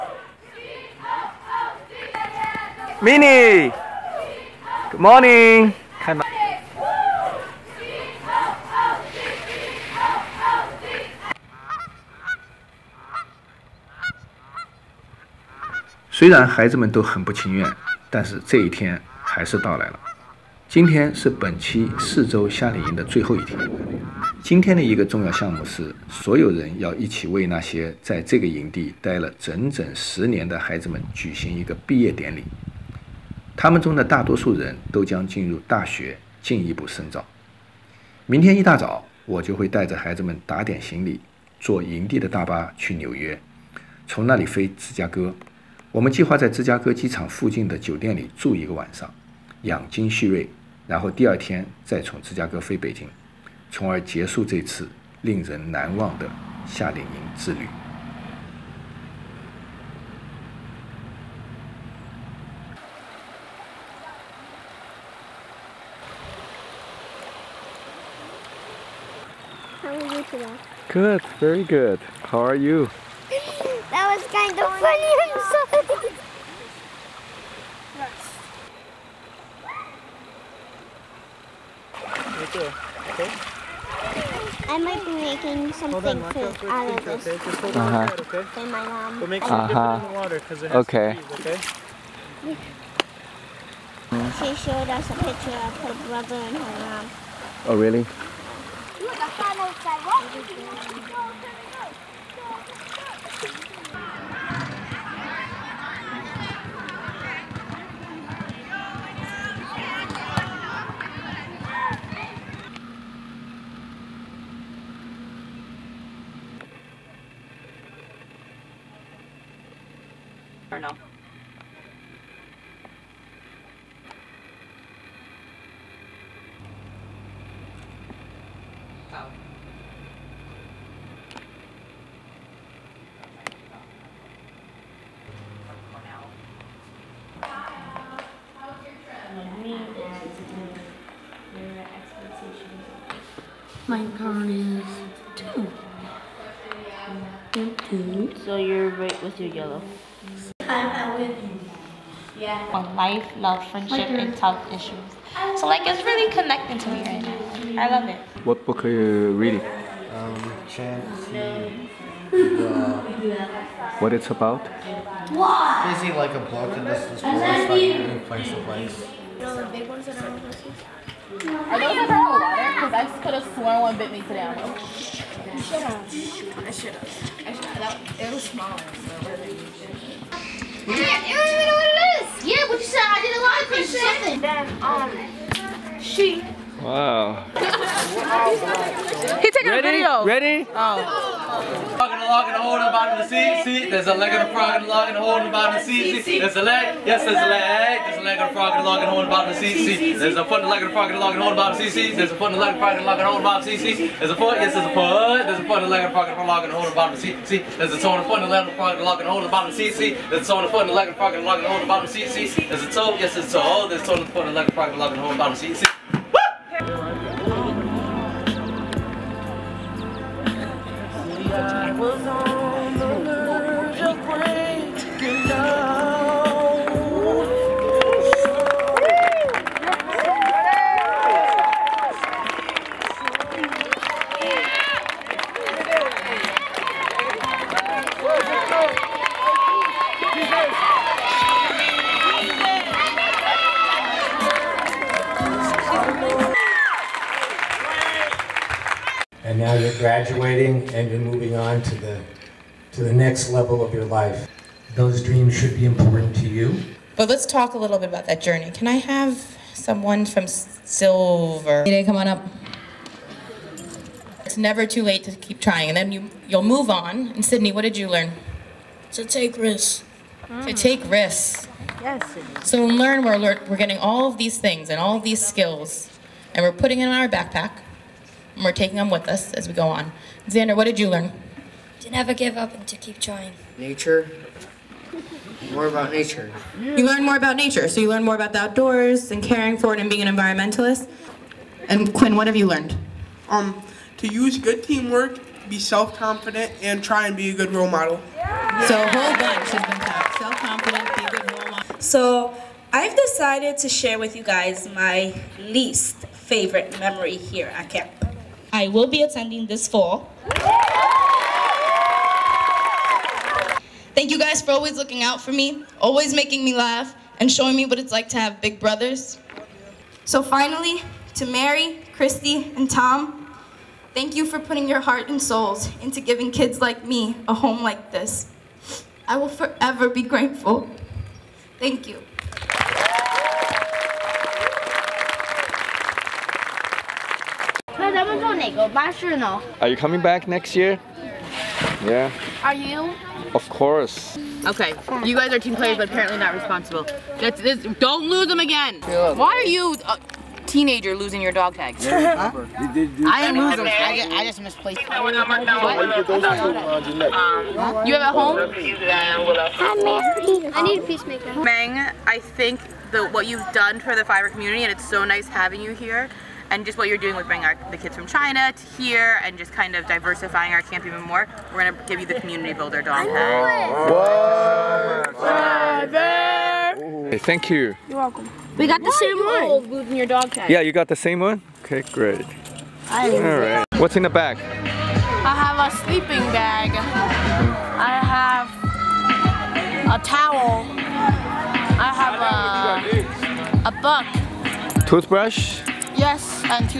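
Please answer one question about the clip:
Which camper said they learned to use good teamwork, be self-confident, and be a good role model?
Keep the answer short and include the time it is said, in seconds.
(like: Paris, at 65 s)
Quinn, at 292 s.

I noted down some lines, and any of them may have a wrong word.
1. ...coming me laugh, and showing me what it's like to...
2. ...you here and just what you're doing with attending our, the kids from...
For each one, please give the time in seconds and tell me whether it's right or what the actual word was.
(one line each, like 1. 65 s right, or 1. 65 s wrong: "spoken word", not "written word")
1. 316 s wrong: "making", not "coming"
2. 365 s wrong: "bringing", not "attending".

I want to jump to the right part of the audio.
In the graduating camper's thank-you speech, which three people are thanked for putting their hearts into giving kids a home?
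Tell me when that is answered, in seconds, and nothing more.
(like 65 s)
321 s.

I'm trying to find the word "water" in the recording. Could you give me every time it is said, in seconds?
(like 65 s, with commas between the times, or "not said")
90 s, 172 s.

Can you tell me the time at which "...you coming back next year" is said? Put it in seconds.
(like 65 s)
339 s.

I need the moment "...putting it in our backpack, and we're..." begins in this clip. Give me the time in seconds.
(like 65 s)
276 s.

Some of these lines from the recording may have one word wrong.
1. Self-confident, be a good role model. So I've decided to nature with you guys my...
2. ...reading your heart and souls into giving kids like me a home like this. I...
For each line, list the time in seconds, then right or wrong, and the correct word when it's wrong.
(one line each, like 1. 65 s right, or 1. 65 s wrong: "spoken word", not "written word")
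1. 300 s wrong: "share", not "nature"
2. 324 s wrong: "putting", not "reading".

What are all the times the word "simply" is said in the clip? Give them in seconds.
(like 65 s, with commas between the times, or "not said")
not said.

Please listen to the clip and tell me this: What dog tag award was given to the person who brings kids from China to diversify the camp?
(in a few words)
Community builder.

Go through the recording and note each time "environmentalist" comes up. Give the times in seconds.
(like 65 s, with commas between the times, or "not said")
290 s.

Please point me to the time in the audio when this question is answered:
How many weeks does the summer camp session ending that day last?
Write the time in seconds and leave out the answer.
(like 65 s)
21 s.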